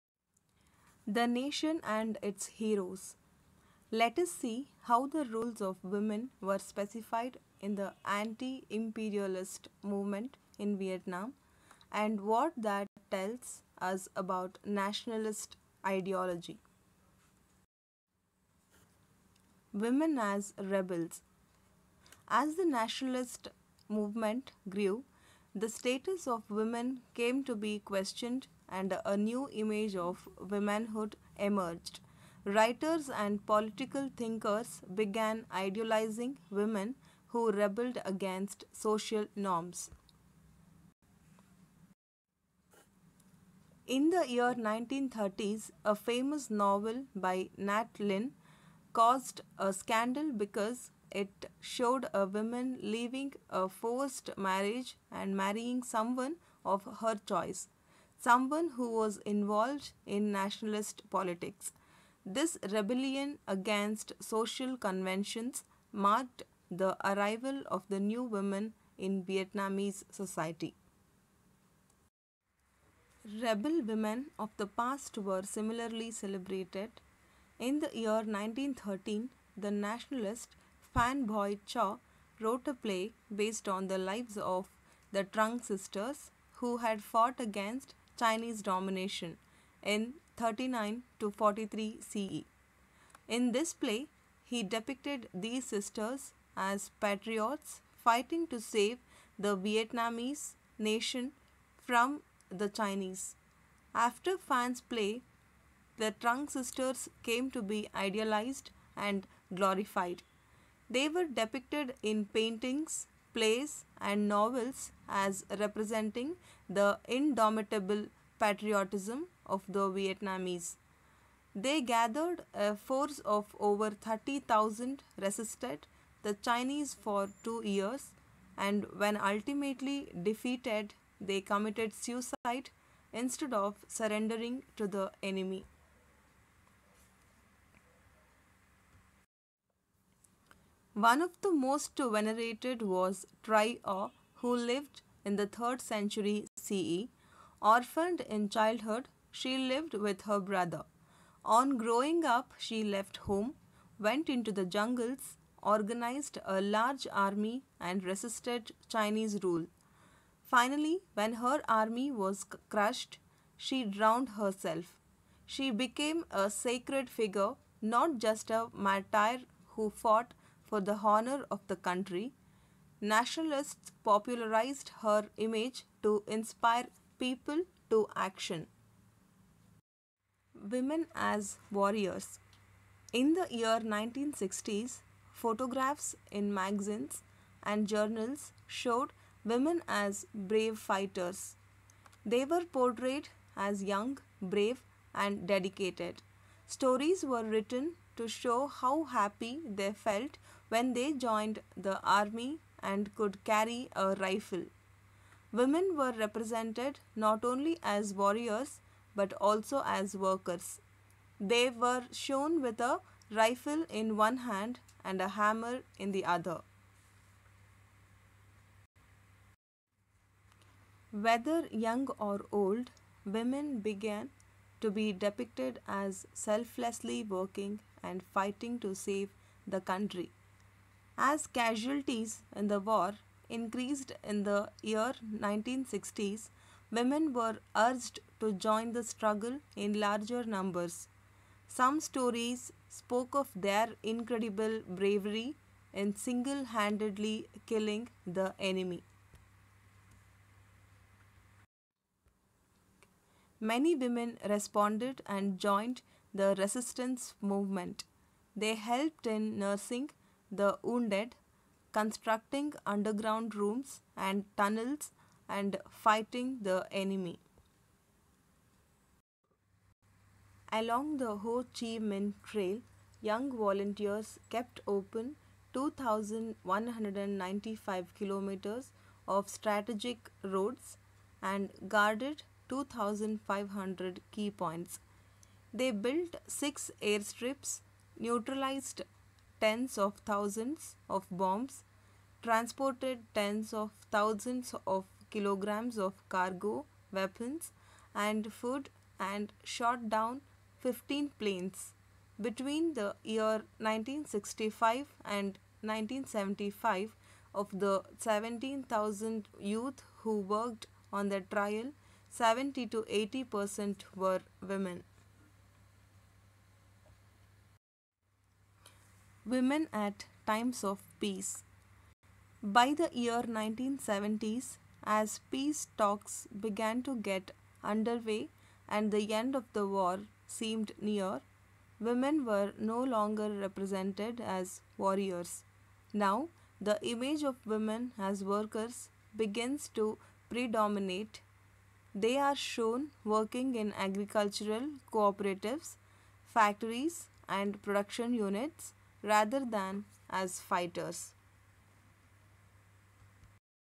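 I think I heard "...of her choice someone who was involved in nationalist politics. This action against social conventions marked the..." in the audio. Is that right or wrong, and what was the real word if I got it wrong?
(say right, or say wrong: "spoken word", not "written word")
wrong: "rebellion", not "action".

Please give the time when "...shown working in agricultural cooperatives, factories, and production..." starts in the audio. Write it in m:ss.
5:42.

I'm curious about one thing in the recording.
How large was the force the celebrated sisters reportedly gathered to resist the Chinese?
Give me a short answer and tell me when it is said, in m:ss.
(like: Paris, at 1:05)
over 30,000, at 2:03.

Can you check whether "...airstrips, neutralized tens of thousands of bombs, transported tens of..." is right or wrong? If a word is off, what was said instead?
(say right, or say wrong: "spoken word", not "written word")
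right.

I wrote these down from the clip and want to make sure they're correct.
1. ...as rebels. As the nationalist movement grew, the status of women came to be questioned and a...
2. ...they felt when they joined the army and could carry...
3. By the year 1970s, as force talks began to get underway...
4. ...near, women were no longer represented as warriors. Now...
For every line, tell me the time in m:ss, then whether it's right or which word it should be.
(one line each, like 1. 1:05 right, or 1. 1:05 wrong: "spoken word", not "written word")
1. 0:20 right
2. 3:19 right
3. 5:22 wrong: "peace", not "force"
4. 5:31 right.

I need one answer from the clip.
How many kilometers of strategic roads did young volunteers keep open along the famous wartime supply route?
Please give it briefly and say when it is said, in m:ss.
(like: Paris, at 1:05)
2,195, at 4:35.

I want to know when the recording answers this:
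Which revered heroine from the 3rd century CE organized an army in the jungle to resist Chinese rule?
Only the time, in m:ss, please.
2:23.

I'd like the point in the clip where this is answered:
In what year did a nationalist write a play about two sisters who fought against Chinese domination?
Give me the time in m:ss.
1:18.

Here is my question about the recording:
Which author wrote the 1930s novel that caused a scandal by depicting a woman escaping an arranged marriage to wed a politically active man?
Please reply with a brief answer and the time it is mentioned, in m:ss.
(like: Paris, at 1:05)
Nhat Linh, at 0:47.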